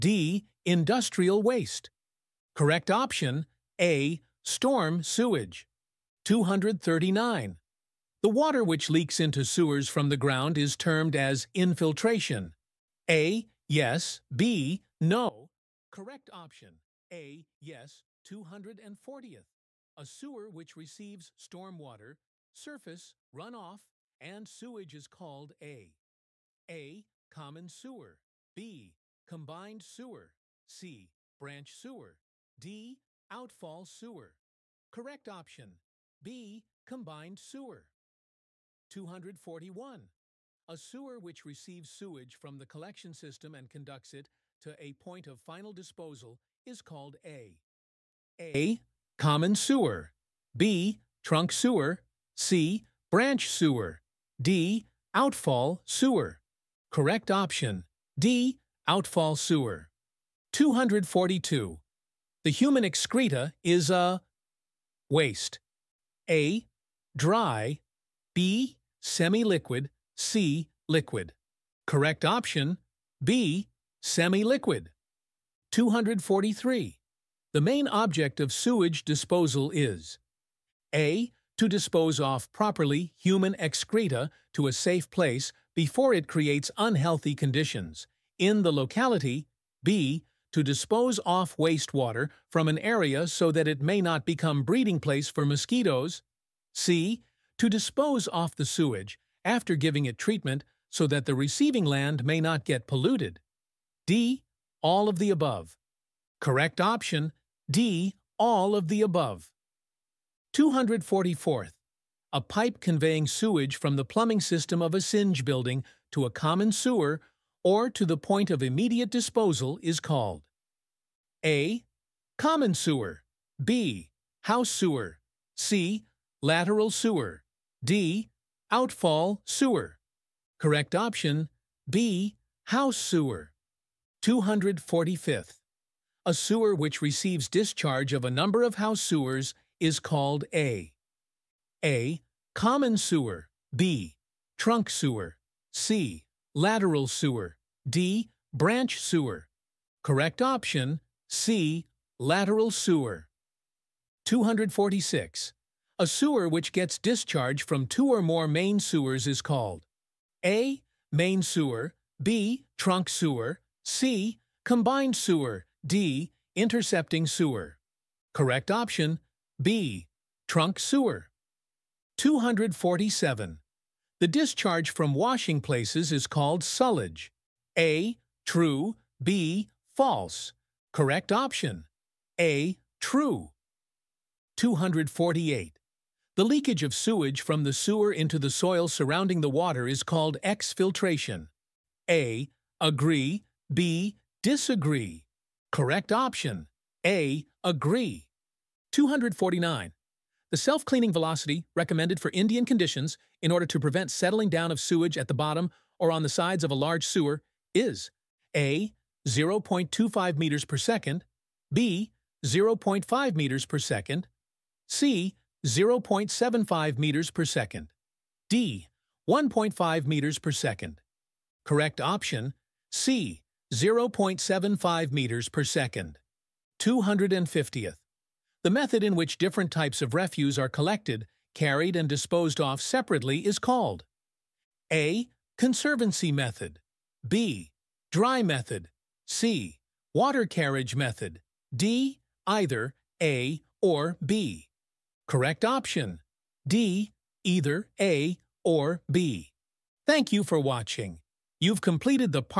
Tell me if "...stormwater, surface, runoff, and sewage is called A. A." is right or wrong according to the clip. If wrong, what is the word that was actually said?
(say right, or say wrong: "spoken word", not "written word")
right.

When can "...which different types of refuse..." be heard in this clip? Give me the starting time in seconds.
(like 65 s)
229 s.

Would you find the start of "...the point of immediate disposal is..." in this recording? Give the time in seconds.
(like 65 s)
118 s.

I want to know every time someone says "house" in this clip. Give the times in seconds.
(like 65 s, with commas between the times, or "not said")
124 s, 132 s, 138 s.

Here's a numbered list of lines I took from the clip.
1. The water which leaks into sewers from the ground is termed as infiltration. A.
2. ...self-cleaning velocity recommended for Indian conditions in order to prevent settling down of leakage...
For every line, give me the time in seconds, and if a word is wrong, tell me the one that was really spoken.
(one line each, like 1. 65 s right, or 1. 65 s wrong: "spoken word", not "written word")
1. 8 s right
2. 200 s wrong: "sewage", not "leakage".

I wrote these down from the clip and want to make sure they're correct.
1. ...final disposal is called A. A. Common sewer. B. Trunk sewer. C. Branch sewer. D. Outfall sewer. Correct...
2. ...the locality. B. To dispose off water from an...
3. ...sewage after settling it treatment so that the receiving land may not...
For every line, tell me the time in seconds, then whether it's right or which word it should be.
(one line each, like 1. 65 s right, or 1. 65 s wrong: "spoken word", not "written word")
1. 45 s right
2. 88 s wrong: "wastewater", not "water"
3. 98 s wrong: "giving", not "settling".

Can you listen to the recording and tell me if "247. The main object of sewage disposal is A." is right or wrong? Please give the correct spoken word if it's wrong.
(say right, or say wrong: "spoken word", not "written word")
wrong: "243", not "247".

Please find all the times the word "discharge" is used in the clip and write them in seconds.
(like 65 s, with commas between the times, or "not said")
137 s, 156 s, 174 s.